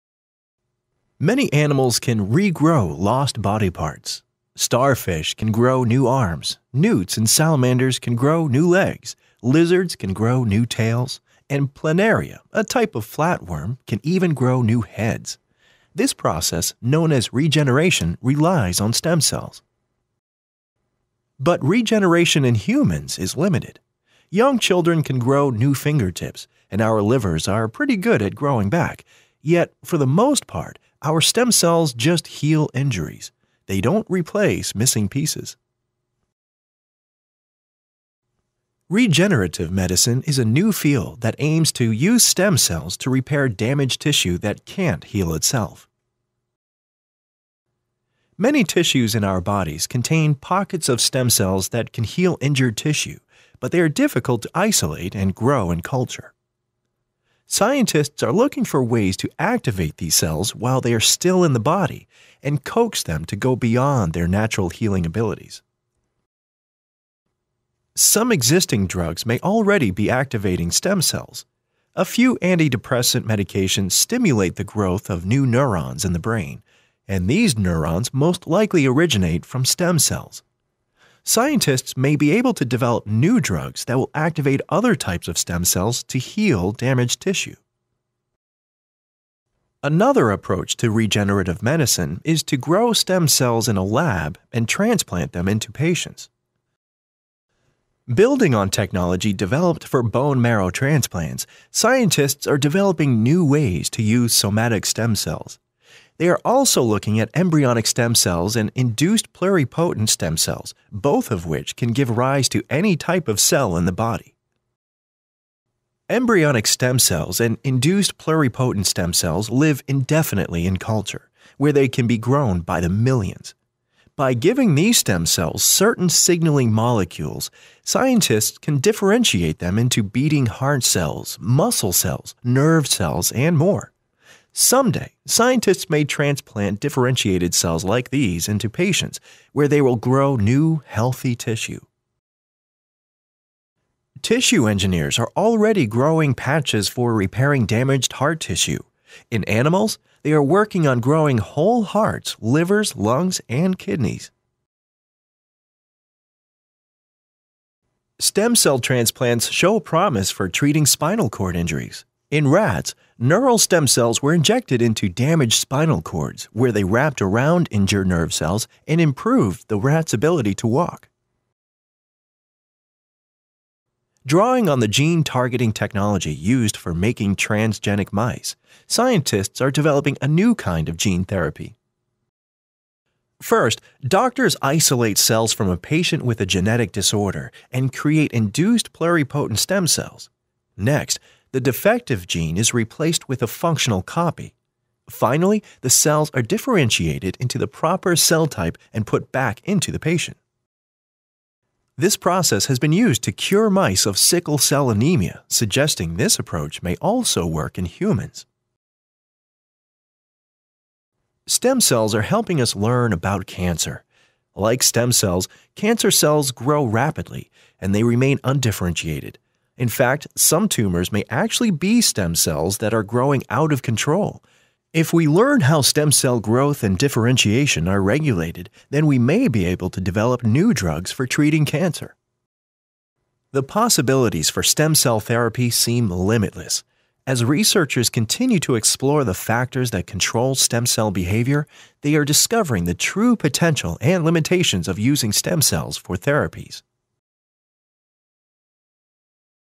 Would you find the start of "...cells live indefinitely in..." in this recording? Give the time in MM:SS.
01:59.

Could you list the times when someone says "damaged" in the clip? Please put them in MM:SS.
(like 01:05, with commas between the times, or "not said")
00:43, 01:26, 02:27, 02:45.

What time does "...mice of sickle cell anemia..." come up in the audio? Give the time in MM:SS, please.
03:23.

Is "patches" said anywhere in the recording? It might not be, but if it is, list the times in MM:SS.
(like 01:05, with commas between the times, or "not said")
02:26.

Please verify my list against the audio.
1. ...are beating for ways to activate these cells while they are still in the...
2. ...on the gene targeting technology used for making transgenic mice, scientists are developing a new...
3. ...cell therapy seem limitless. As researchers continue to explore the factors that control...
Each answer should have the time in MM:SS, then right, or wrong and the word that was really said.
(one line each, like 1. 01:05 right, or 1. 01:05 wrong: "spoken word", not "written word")
1. 00:58 wrong: "looking", not "beating"
2. 02:54 right
3. 03:54 right.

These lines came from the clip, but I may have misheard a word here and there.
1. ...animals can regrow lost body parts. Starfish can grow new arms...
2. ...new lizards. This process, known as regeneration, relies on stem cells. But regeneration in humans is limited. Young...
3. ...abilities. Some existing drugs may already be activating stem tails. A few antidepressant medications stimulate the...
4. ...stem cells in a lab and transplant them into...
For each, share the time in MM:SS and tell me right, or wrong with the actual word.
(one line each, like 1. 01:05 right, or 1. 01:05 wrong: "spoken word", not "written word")
1. 00:01 right
2. 00:14 wrong: "heads", not "lizards"
3. 01:05 wrong: "cells", not "tails"
4. 01:32 right.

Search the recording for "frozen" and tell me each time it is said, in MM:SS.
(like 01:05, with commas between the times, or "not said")
not said.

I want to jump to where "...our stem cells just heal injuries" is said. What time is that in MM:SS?
00:31.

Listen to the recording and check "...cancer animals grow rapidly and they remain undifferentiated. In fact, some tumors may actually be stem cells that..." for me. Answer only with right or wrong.
wrong.